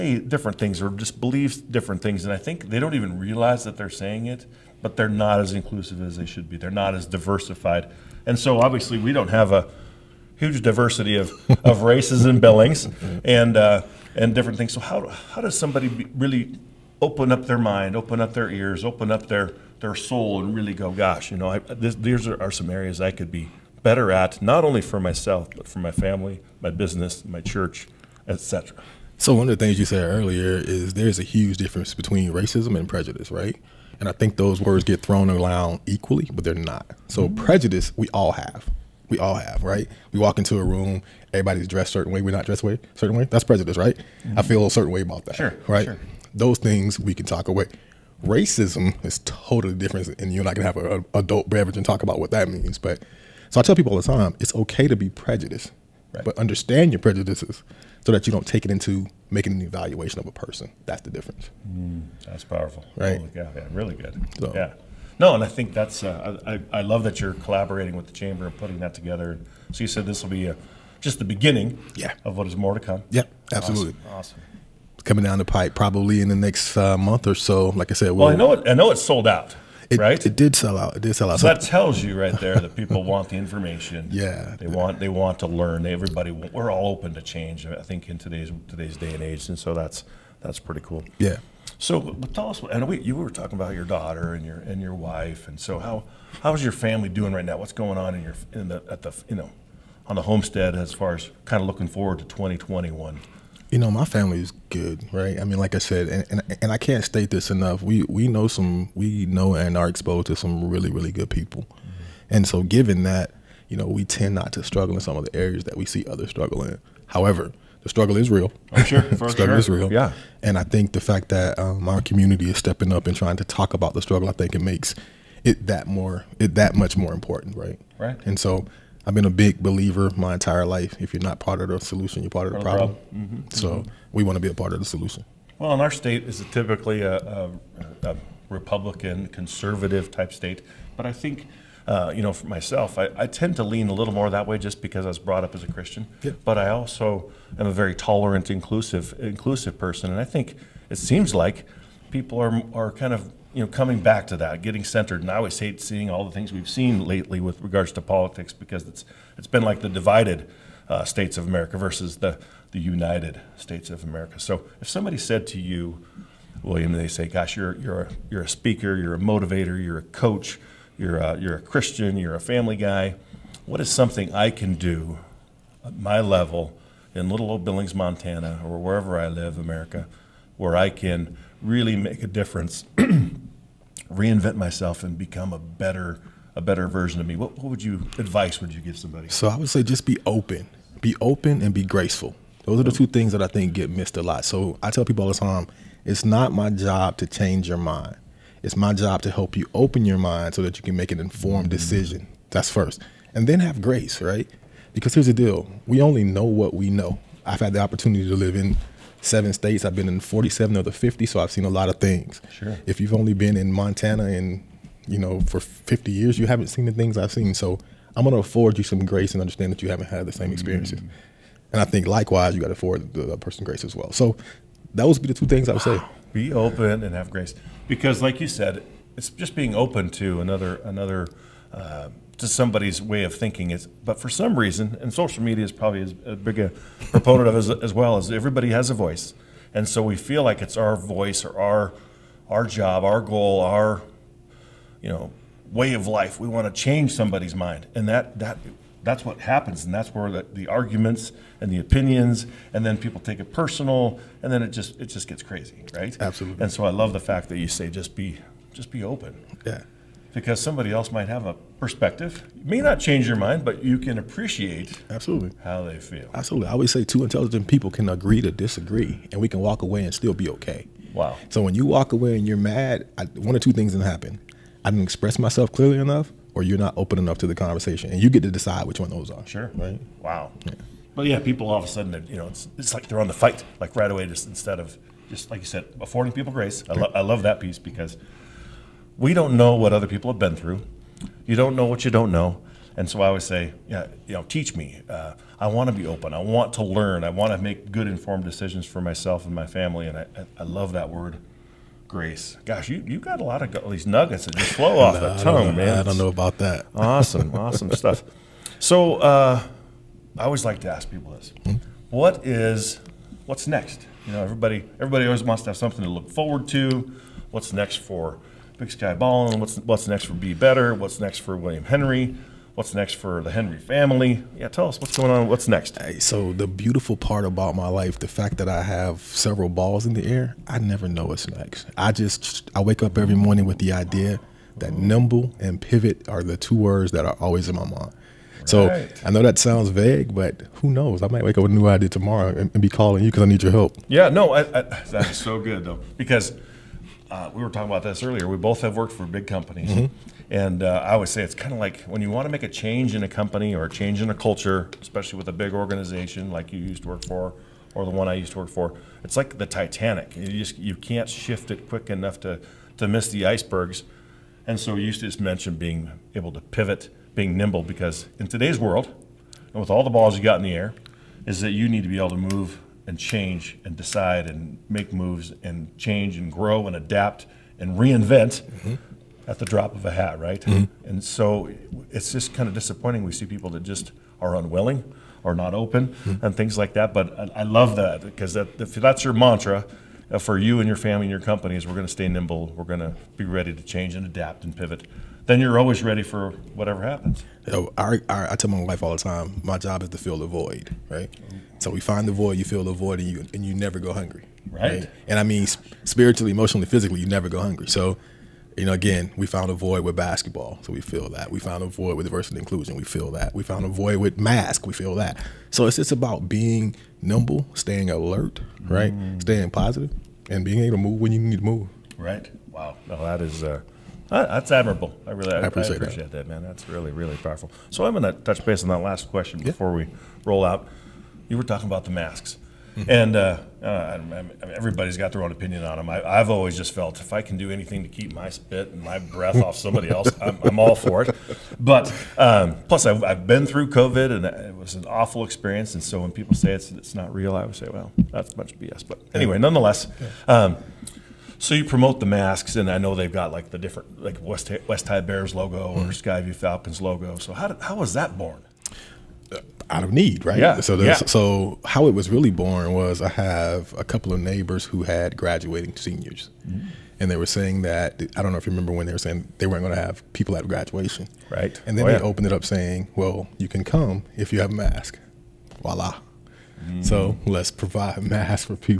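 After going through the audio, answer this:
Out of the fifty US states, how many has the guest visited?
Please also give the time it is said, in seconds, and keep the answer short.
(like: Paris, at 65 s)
47, at 210 s.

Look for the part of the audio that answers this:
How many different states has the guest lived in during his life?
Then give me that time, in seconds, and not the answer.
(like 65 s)
209 s.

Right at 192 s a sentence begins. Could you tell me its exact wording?
Those are the two things that I think get missed a lot.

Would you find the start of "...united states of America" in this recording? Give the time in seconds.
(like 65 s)
162 s.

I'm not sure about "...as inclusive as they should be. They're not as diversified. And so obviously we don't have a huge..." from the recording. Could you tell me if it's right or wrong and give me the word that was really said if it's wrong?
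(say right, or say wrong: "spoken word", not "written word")
right.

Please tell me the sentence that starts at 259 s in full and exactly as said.
Yeah because somebody else might have a perspective.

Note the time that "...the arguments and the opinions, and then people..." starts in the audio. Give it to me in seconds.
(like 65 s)
250 s.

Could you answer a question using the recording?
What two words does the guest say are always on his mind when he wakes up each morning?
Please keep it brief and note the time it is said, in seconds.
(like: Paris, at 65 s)
Nimble and pivot, at 334 s.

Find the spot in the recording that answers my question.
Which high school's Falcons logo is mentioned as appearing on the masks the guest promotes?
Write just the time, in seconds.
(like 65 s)
456 s.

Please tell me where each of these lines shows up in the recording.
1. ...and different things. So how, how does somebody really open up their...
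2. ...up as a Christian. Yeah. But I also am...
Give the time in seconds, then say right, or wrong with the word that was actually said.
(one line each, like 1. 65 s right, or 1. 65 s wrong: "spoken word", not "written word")
1. 14 s right
2. 145 s right.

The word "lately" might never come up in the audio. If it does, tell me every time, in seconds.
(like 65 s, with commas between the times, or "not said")
157 s.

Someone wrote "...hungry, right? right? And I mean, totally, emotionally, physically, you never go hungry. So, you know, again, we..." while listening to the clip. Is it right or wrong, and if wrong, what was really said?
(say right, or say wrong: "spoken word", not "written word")
wrong: "spiritually", not "totally".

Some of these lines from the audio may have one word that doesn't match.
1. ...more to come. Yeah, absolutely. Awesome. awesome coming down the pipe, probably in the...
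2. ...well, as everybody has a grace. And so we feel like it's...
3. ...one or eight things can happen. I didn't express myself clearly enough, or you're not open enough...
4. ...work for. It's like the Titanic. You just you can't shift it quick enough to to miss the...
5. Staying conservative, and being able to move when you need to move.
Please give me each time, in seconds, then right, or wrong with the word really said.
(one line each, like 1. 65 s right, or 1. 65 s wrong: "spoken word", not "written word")
1. 72 s right
2. 237 s wrong: "voice", not "grace"
3. 273 s wrong: "two", not "eight"
4. 358 s right
5. 419 s wrong: "positive", not "conservative".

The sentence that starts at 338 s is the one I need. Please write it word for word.
So I know that sounds vague, but who knows?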